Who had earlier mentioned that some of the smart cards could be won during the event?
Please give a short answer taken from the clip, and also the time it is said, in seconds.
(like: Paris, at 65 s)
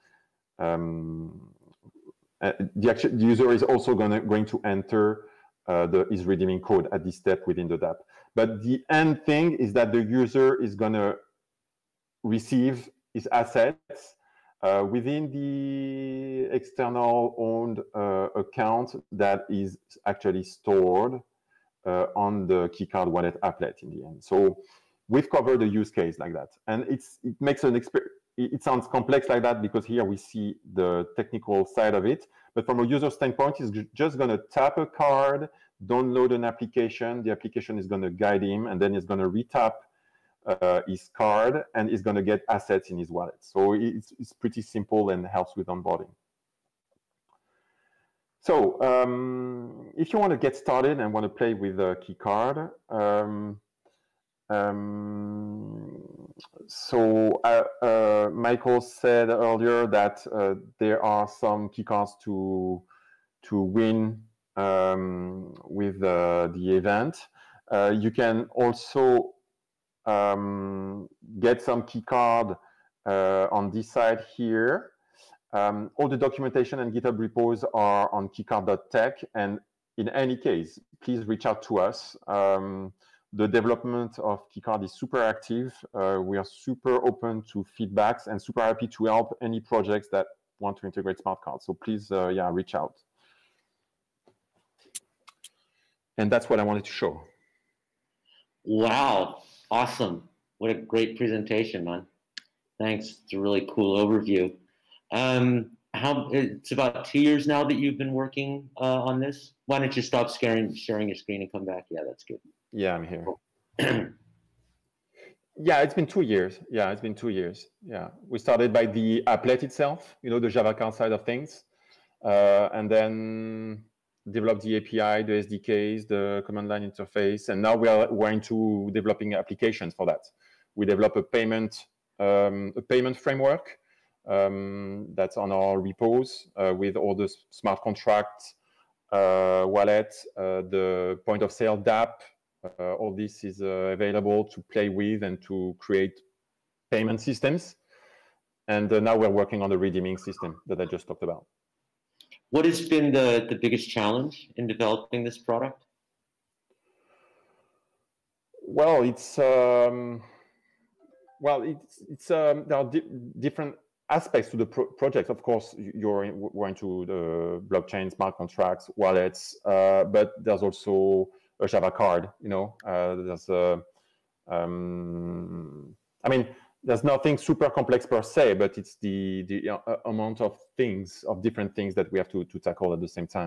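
Michael, at 58 s.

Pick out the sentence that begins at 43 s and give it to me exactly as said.
So it's, it's pretty simple and helps with onboarding.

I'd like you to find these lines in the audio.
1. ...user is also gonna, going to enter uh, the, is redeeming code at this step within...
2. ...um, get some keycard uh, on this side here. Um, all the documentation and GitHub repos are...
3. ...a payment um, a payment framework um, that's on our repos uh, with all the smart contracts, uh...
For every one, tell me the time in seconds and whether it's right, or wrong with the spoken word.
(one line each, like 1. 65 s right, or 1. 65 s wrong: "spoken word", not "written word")
1. 3 s right
2. 70 s right
3. 131 s right.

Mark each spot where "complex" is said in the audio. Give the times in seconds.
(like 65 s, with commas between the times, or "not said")
28 s, 177 s.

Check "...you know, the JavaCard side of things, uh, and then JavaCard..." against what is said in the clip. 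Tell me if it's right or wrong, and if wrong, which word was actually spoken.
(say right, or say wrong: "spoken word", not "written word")
wrong: "Develop", not "JavaCard".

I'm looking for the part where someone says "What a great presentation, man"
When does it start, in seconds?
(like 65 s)
100 s.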